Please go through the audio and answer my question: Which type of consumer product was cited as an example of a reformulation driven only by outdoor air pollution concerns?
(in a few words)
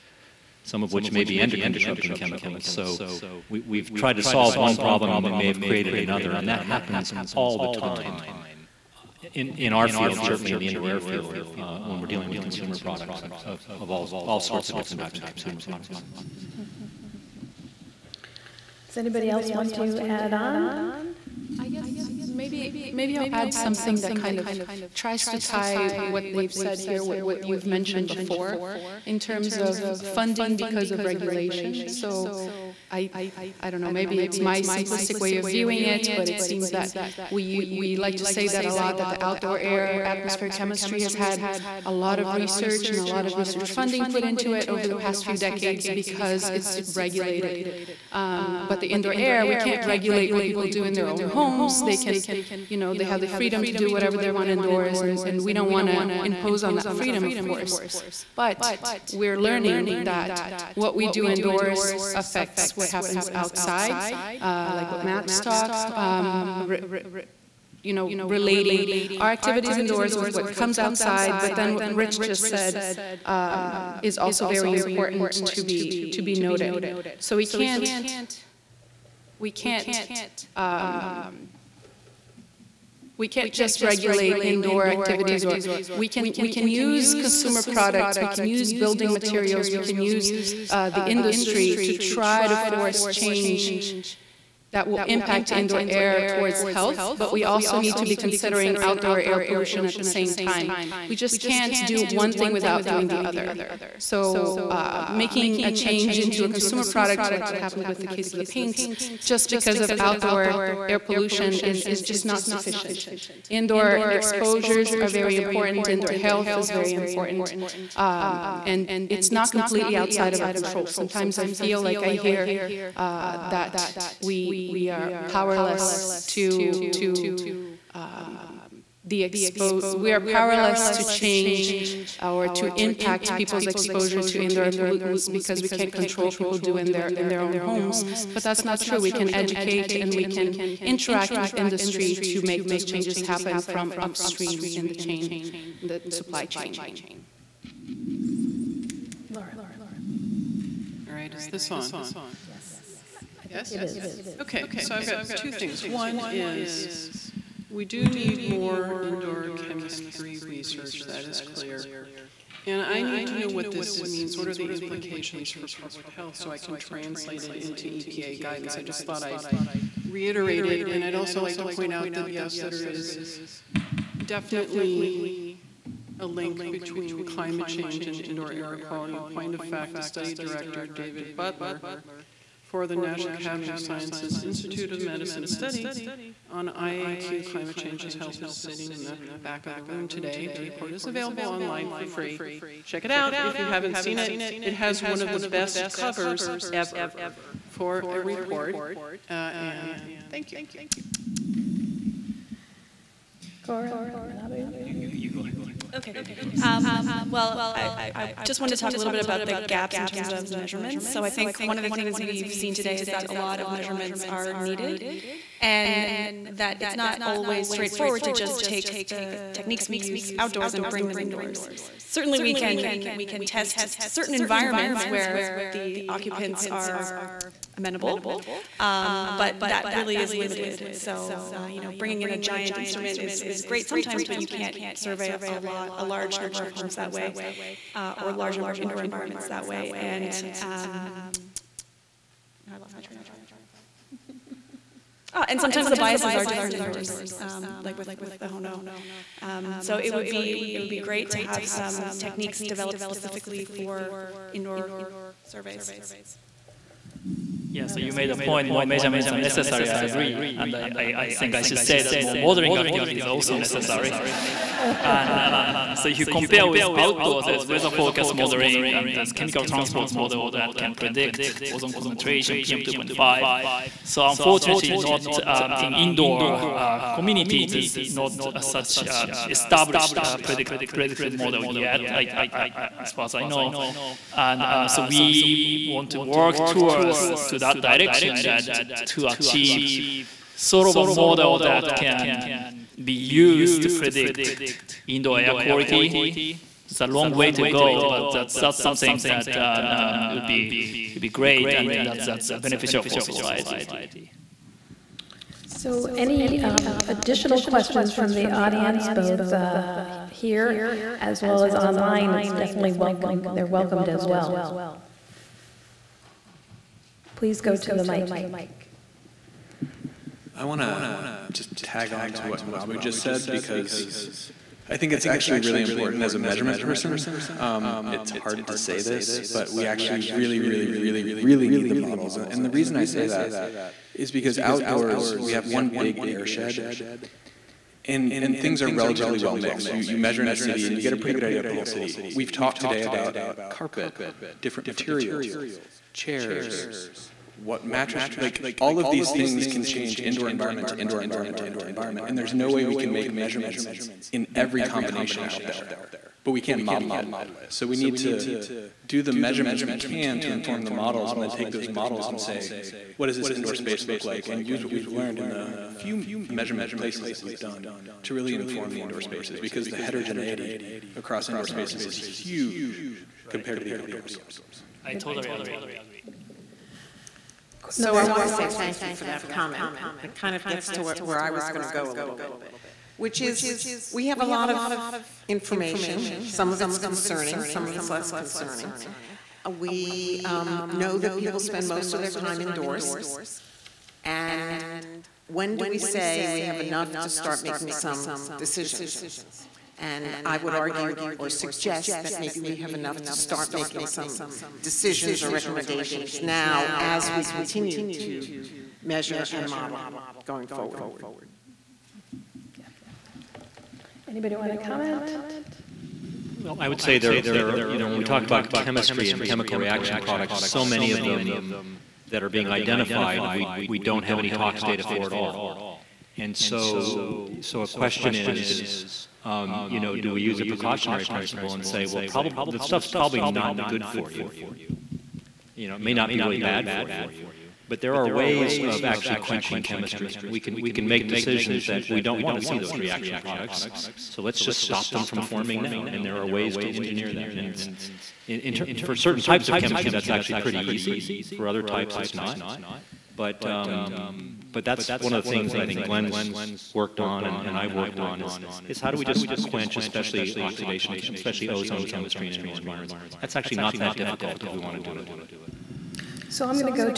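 paints.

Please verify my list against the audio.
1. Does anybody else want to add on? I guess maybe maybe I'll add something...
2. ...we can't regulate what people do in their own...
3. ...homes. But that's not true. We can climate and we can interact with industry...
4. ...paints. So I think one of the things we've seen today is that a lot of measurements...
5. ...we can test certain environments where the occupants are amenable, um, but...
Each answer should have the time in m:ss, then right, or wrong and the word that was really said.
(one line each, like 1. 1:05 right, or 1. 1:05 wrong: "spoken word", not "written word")
1. 0:18 right
2. 0:49 right
3. 2:17 wrong: "educate", not "climate"
4. 3:30 wrong: "measurements", not "paints"
5. 3:43 right.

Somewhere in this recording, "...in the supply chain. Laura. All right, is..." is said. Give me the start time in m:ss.
2:25.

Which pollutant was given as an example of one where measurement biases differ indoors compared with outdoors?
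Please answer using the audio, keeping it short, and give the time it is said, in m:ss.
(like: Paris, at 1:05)
HONO, at 4:08.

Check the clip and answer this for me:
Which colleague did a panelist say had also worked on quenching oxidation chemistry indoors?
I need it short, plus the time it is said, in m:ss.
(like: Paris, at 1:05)
Glenn, at 7:36.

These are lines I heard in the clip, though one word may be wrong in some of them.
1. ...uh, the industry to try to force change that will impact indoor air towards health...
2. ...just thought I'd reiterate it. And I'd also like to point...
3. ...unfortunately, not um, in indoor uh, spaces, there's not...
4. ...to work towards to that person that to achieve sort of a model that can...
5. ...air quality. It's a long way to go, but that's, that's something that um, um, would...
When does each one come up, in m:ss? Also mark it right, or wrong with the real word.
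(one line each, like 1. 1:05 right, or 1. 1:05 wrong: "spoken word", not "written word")
1. 1:30 right
2. 2:48 right
3. 4:34 wrong: "communities", not "spaces"
4. 4:46 wrong: "direction", not "person"
5. 4:55 right.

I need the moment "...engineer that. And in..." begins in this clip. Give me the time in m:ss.
7:26.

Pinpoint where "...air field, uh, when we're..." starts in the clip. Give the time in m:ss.
0:10.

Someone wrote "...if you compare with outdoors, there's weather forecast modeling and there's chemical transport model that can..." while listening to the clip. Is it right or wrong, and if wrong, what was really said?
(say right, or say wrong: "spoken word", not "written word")
right.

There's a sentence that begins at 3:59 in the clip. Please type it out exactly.
And um, I lost my train of thought.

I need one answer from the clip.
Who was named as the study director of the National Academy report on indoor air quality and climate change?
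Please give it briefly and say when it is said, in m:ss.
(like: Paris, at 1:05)
David Butler, at 3:00.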